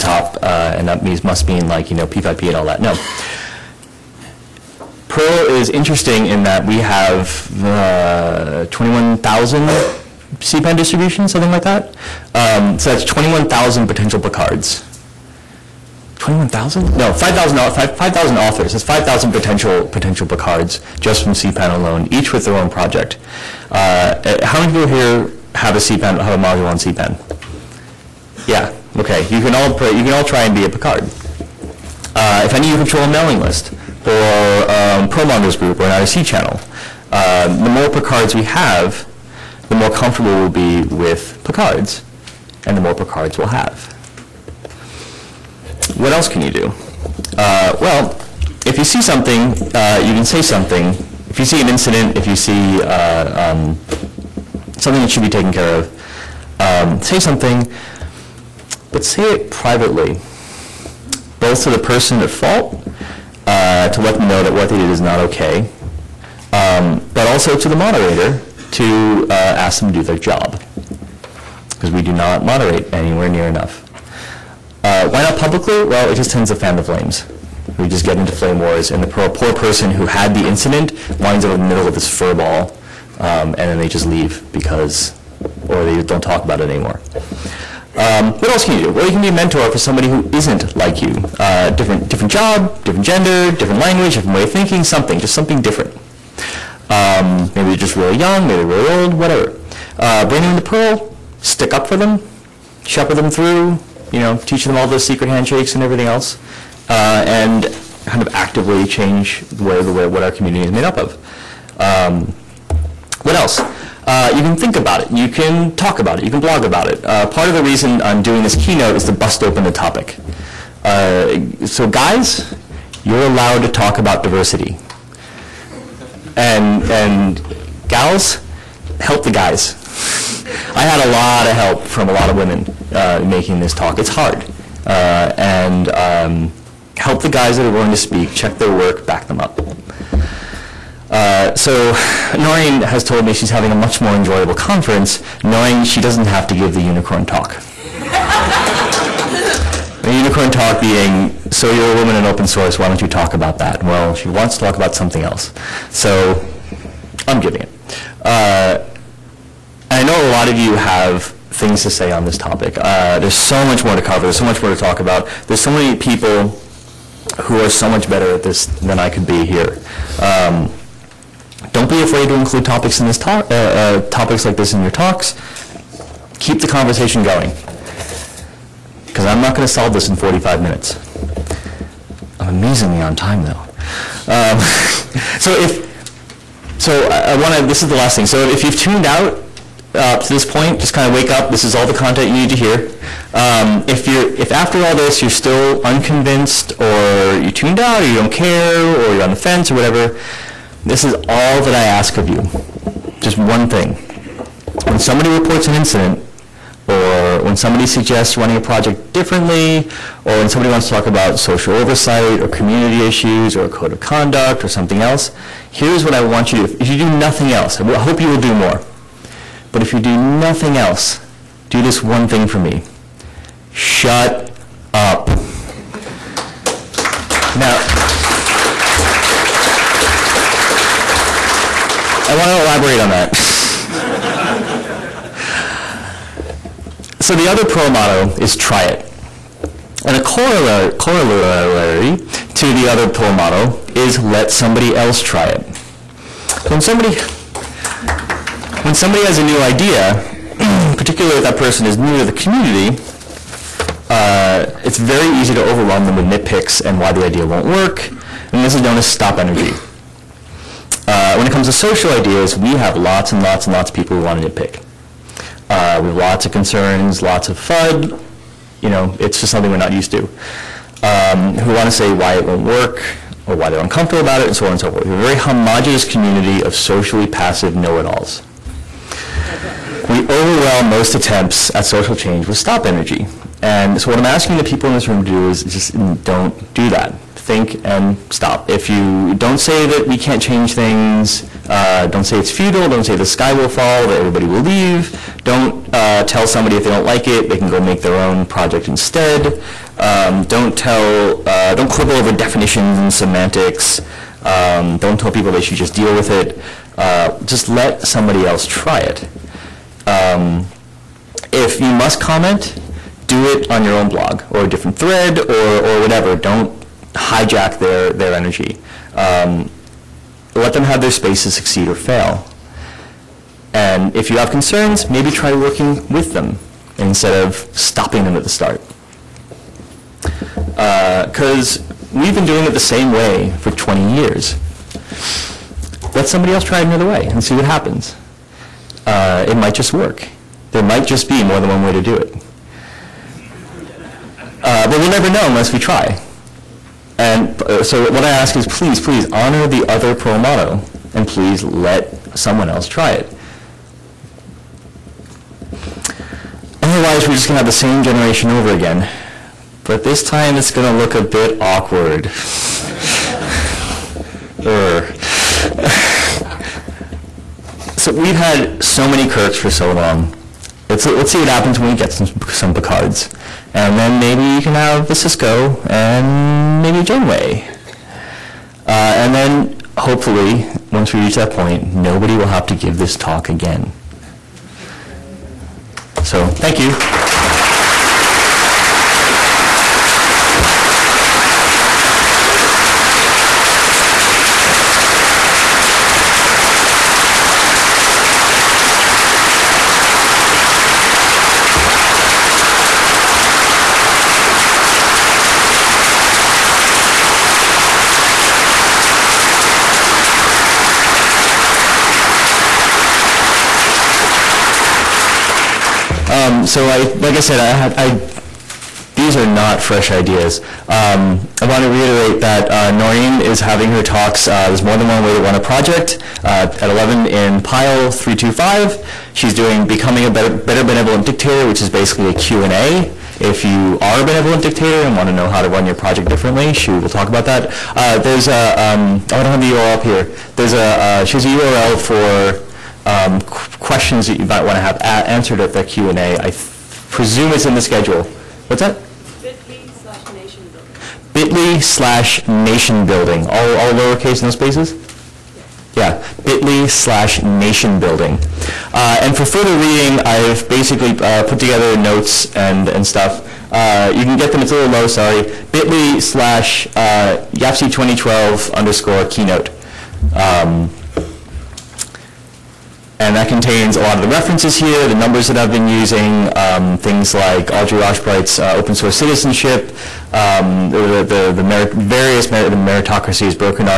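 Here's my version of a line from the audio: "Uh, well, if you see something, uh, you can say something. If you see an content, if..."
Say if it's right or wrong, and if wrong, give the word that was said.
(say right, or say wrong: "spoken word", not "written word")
wrong: "incident", not "content".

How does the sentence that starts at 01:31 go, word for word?
Uh, different, different job, different gender, different language, different way of thinking, something, just something different.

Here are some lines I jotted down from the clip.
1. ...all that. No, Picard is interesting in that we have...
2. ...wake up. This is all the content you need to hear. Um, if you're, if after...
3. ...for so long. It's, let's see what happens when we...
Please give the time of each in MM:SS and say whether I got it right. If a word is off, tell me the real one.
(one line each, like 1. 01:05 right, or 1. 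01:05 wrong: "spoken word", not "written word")
1. 00:02 wrong: "Perl", not "Picard"
2. 03:11 right
3. 06:09 right.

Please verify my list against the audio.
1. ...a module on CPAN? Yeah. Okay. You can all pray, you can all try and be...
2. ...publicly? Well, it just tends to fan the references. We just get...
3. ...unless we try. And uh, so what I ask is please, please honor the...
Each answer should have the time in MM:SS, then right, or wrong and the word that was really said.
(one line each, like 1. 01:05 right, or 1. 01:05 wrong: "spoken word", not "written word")
1. 00:26 right
2. 01:15 wrong: "flames", not "references"
3. 05:45 right.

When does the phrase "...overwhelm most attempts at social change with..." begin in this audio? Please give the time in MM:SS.
04:40.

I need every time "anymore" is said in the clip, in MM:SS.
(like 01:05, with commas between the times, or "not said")
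01:26.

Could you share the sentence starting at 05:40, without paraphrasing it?
There might just be more than one way to do it.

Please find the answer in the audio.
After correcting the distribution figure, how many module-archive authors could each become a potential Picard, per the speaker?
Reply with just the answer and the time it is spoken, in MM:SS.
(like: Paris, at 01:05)
5,000, at 00:17.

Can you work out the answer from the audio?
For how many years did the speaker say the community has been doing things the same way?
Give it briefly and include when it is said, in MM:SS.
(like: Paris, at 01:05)
20, at 05:33.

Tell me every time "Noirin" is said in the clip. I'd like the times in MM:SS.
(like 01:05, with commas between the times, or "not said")
02:22, 07:02.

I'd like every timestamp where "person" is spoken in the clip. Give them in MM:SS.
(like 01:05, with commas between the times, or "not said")
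01:01, 01:19, 04:11.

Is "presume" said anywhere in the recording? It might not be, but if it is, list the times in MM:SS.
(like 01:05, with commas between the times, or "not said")
07:27.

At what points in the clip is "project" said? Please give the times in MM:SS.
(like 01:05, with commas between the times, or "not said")
00:22, 03:28, 04:58, 07:05, 07:15.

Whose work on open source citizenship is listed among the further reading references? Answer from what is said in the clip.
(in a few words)
Audrey Eschright.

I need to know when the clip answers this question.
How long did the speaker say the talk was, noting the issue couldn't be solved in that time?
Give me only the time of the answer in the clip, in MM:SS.
03:00.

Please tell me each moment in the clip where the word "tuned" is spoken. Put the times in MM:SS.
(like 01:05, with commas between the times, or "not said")
03:08, 03:17.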